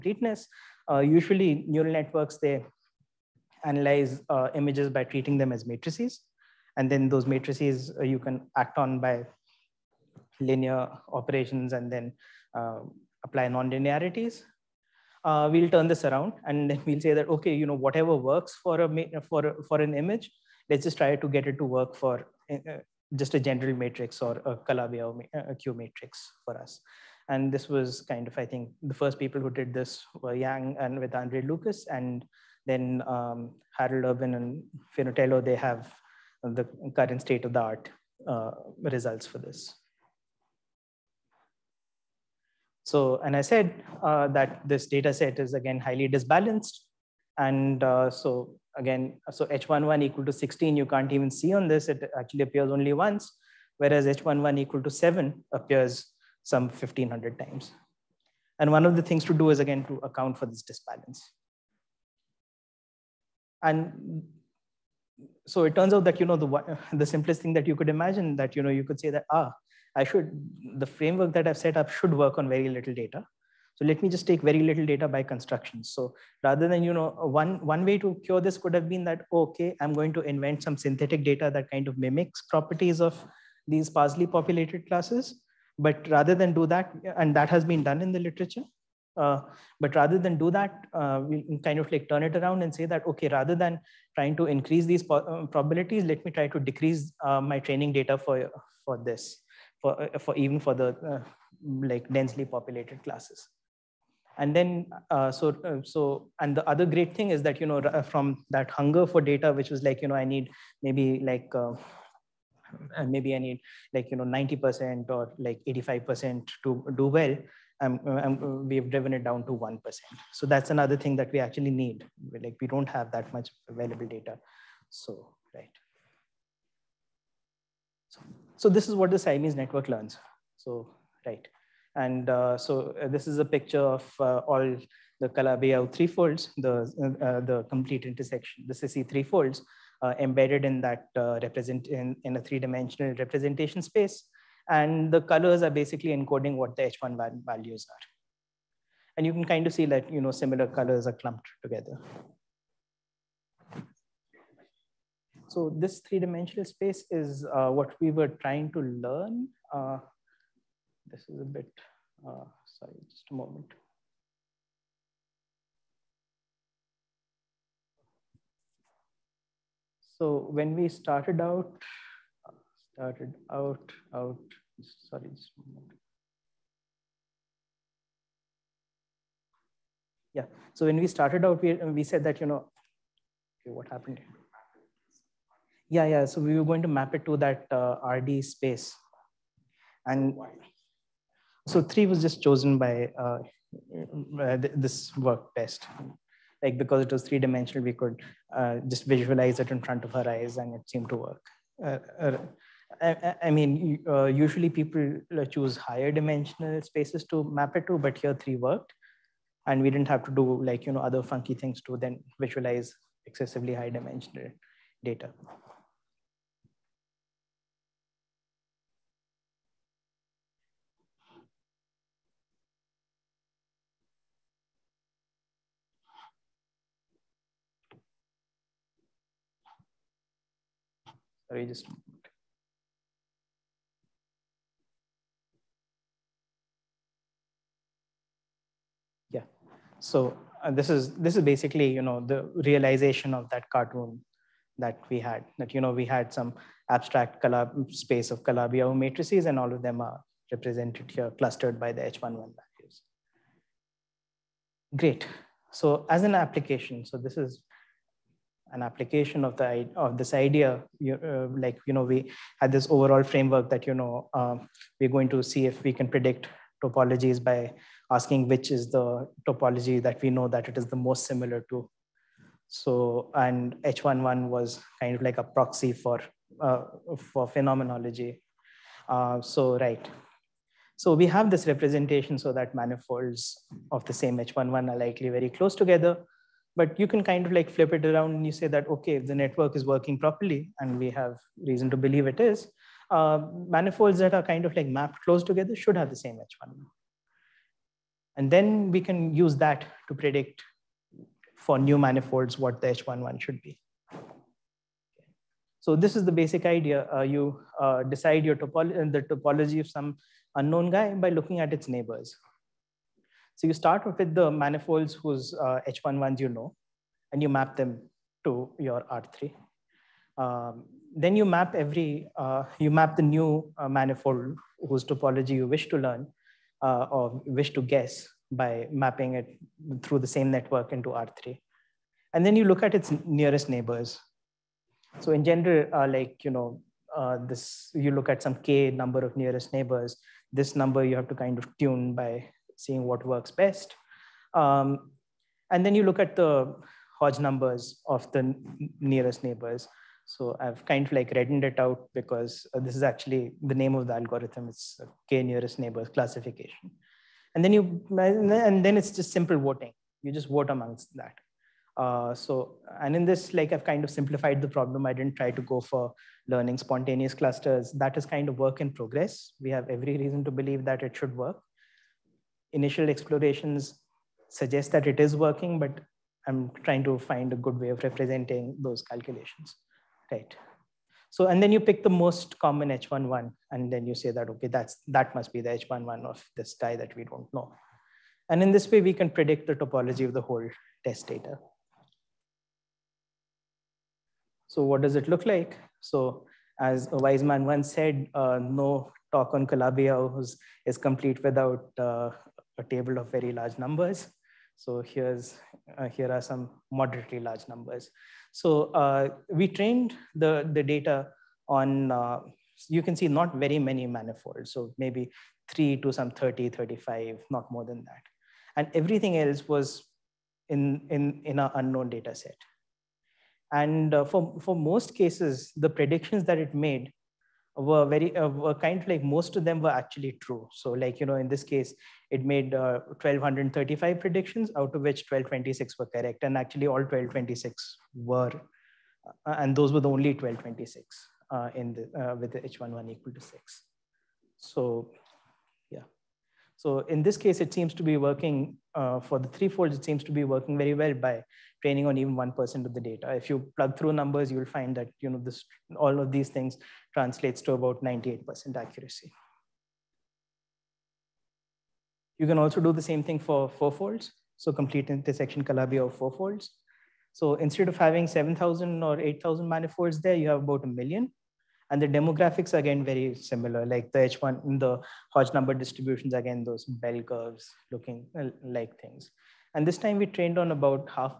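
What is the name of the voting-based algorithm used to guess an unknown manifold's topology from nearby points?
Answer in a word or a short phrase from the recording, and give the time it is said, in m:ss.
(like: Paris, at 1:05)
k nearest neighbors classification, at 5:55.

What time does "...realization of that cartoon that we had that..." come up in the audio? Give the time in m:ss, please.
4:02.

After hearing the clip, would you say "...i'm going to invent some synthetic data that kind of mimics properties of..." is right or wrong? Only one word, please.
right.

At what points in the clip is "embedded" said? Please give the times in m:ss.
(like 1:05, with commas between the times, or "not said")
2:20.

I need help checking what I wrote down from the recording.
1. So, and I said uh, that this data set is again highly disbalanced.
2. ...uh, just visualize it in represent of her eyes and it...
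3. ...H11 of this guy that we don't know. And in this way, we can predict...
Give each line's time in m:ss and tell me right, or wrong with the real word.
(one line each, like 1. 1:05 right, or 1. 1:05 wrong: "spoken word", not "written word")
1. 0:42 right
2. 3:18 wrong: "front", not "represent"
3. 6:25 right.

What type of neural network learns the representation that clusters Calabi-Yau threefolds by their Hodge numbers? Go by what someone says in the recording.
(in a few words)
Siamese network.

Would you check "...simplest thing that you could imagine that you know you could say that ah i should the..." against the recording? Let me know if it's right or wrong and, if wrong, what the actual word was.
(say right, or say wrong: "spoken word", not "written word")
right.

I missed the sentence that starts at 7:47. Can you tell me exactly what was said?
So instead of having 7,000 or 8,000 manifolds there, you have about a million.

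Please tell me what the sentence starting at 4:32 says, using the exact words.
So, and H11 was kind of like a proxy for, uh, for phenomenology.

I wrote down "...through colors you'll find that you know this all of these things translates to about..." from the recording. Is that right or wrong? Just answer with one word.
wrong.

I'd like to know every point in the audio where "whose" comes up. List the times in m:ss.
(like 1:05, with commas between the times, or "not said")
5:15, 5:24.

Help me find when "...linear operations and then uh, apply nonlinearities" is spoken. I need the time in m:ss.
0:10.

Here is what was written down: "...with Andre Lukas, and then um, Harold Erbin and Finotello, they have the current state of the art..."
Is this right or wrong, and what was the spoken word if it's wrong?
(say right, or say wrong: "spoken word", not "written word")
right.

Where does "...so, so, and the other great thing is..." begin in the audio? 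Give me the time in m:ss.
1:45.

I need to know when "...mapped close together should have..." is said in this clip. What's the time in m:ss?
4:54.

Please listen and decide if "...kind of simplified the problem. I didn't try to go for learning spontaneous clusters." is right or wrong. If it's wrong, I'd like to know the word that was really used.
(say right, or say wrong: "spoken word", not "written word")
right.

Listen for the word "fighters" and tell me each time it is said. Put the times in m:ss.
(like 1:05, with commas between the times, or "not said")
not said.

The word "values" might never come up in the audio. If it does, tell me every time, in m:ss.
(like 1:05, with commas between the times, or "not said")
2:27, 4:12.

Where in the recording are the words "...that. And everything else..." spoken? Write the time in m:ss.
6:58.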